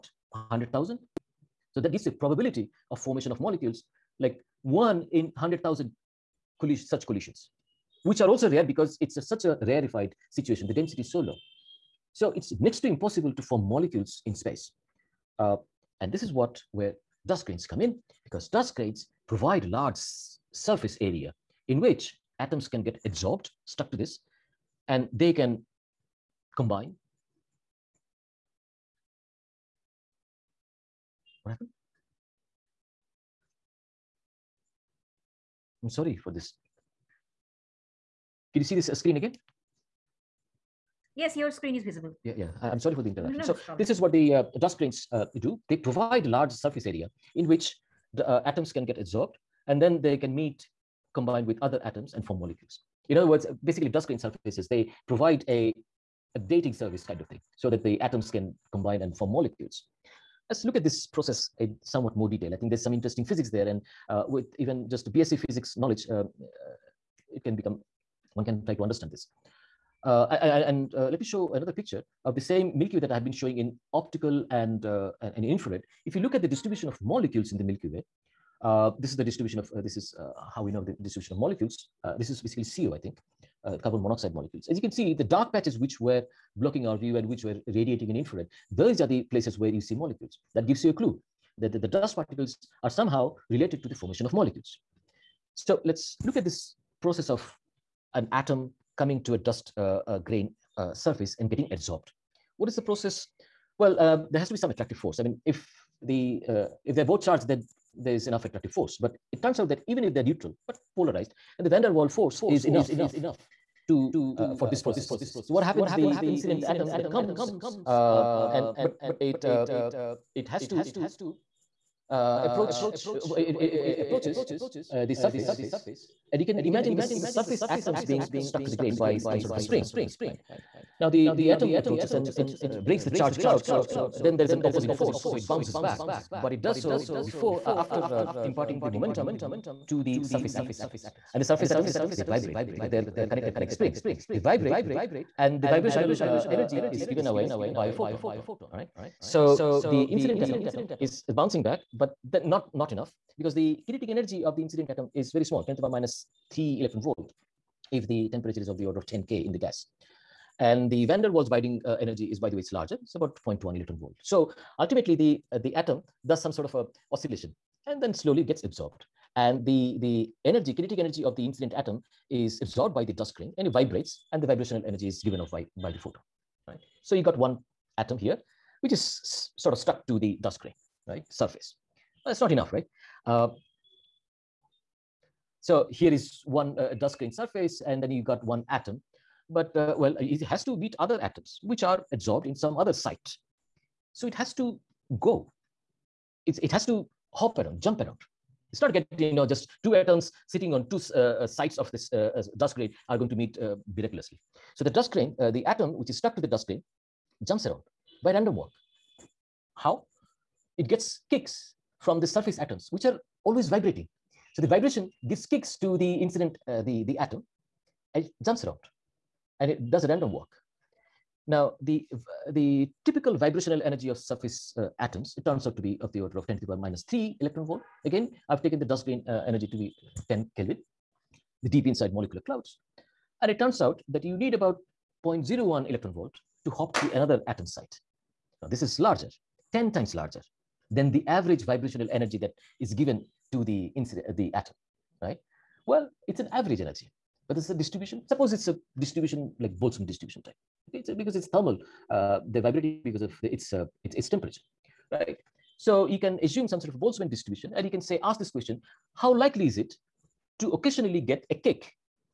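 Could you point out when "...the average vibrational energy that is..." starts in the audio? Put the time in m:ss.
4:01.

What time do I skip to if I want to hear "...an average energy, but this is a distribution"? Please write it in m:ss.
4:06.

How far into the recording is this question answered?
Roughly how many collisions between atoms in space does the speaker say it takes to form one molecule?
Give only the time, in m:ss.
0:04.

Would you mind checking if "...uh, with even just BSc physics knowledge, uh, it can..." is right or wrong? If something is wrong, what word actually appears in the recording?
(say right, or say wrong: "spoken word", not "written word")
right.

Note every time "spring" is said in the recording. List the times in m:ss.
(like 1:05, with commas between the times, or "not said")
2:09, 2:23.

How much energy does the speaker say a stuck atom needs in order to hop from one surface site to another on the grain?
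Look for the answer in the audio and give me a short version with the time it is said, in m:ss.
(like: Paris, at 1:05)
0.01 electron volt, at 3:55.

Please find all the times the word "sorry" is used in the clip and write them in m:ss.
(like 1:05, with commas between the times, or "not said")
0:35, 0:42.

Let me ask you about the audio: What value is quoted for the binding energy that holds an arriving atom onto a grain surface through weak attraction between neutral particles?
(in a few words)
0.1 electron volt.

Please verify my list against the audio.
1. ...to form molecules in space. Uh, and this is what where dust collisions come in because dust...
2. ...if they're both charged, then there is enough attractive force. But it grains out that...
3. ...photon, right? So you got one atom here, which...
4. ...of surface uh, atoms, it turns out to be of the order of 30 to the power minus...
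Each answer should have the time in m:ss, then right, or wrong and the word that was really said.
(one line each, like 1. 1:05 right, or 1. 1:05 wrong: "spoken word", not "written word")
1. 0:13 wrong: "grains", not "collisions"
2. 1:46 wrong: "turns", not "grains"
3. 2:55 right
4. 3:44 wrong: "10", not "30".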